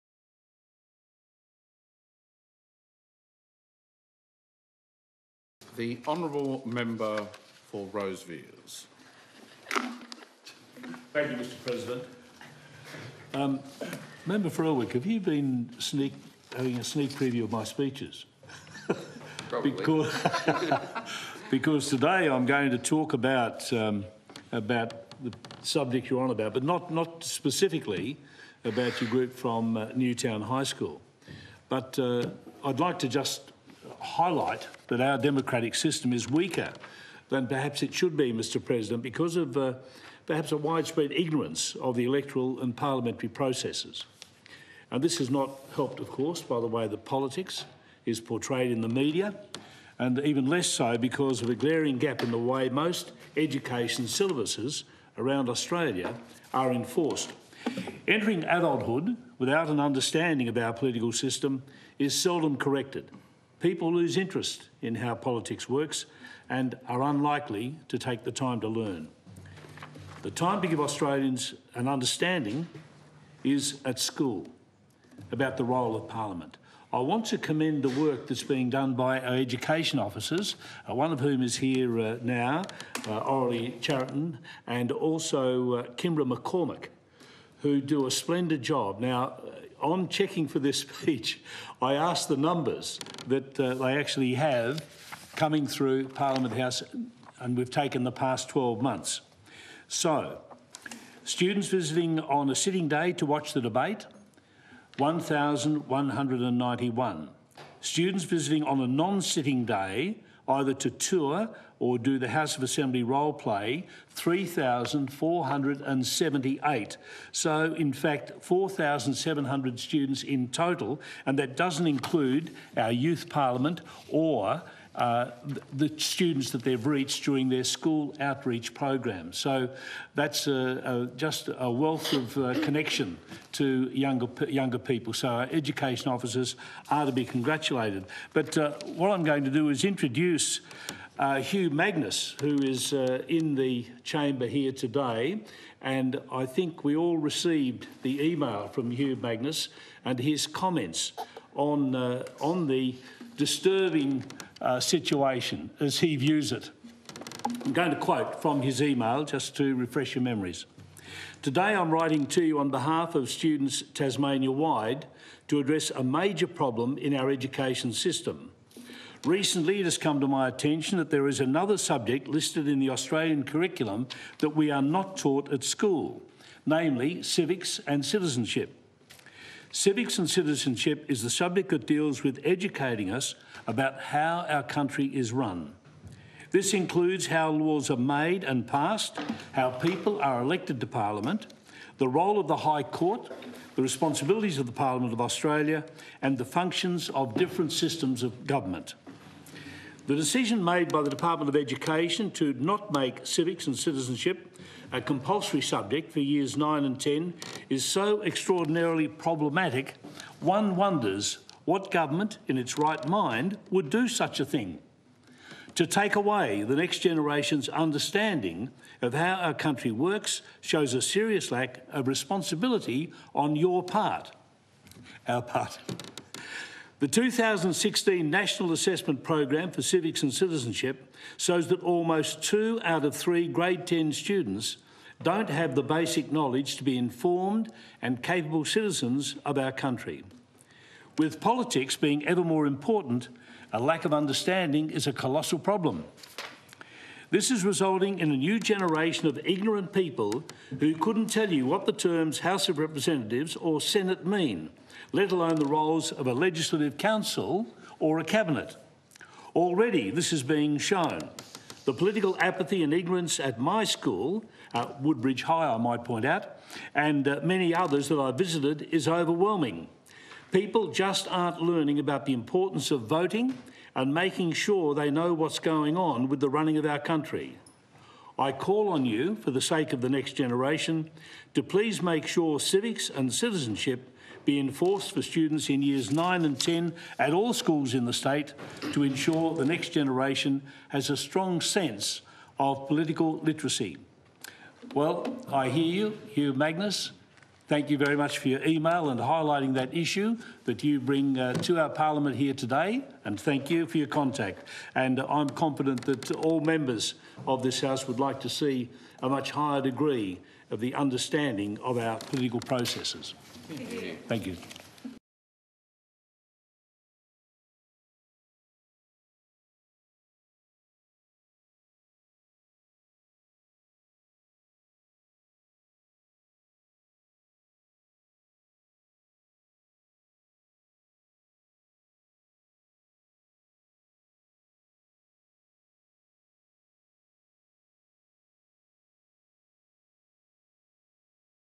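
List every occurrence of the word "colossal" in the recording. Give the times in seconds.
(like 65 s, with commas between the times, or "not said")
245 s.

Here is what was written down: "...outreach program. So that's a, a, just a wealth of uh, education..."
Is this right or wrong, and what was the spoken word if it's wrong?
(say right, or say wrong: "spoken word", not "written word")
wrong: "connection", not "education".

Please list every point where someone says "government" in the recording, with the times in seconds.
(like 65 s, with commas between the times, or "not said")
198 s, 211 s.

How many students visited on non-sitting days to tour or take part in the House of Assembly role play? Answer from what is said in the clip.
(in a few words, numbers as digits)
3,478.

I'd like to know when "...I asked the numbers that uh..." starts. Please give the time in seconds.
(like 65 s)
91 s.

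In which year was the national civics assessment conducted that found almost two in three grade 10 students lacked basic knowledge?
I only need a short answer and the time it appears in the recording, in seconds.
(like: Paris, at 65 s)
2016, at 227 s.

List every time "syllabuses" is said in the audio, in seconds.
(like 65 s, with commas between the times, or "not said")
54 s.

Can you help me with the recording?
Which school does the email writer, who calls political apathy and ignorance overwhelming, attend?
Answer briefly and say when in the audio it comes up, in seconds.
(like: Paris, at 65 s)
Woodbridge High, at 265 s.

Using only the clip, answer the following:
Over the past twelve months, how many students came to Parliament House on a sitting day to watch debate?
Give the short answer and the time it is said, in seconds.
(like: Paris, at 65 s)
1,191, at 104 s.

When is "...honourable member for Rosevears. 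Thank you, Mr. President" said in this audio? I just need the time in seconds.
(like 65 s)
6 s.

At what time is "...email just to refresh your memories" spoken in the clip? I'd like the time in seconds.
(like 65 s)
158 s.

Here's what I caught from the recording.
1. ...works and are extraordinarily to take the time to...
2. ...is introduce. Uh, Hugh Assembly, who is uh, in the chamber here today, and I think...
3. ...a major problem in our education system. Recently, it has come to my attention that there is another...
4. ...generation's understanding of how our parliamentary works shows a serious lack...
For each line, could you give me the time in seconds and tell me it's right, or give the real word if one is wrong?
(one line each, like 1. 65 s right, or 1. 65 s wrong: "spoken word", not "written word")
1. 65 s wrong: "unlikely", not "extraordinarily"
2. 139 s wrong: "Magnus", not "Assembly"
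3. 165 s right
4. 216 s wrong: "country", not "parliamentary".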